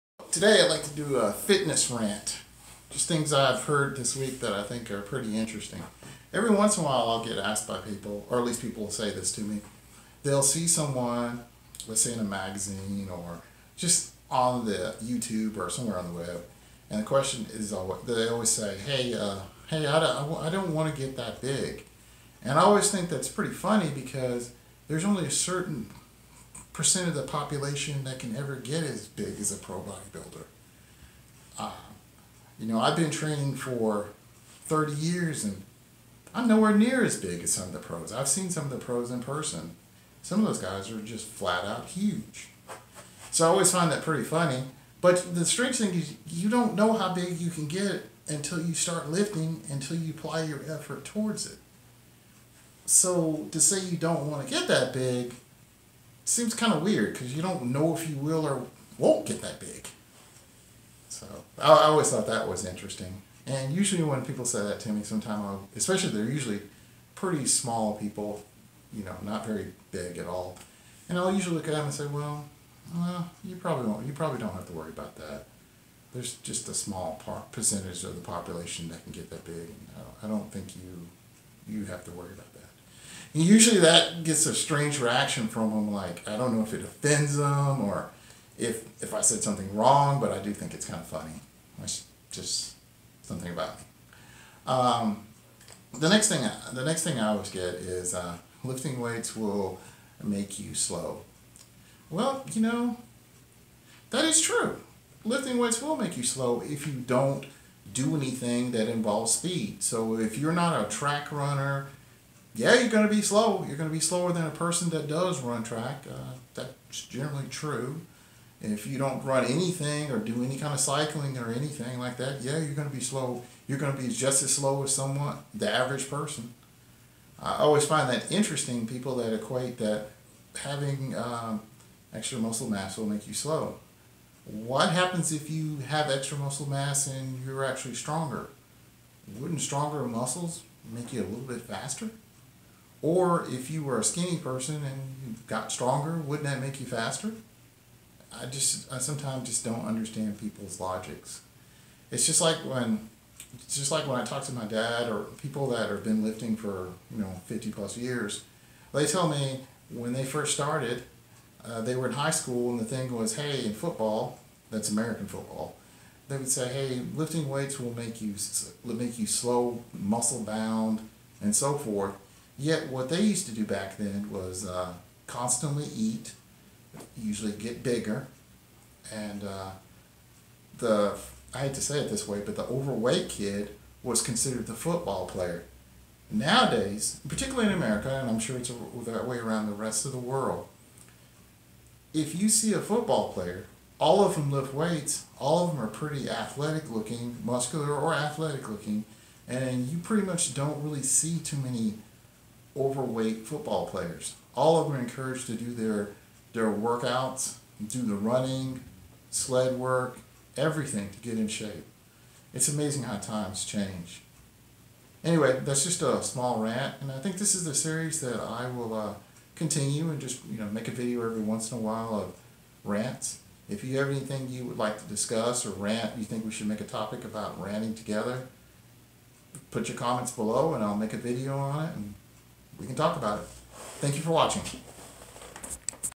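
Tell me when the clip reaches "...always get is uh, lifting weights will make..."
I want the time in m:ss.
1:37.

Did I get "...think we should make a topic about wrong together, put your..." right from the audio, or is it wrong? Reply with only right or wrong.
wrong.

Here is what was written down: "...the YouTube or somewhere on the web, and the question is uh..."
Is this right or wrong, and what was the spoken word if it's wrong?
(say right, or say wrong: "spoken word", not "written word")
right.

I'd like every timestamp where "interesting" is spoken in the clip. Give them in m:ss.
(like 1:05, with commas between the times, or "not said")
0:05, 1:02, 2:08.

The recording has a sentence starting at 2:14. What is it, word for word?
What happens if you have extra muscle mass and you're actually stronger?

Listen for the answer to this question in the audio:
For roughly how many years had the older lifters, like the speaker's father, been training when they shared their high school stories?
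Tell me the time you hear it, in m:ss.
2:37.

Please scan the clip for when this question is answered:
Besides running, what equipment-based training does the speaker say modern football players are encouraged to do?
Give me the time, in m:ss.
3:29.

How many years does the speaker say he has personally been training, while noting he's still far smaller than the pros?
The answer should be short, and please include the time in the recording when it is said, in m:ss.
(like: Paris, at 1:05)
30, at 0:34.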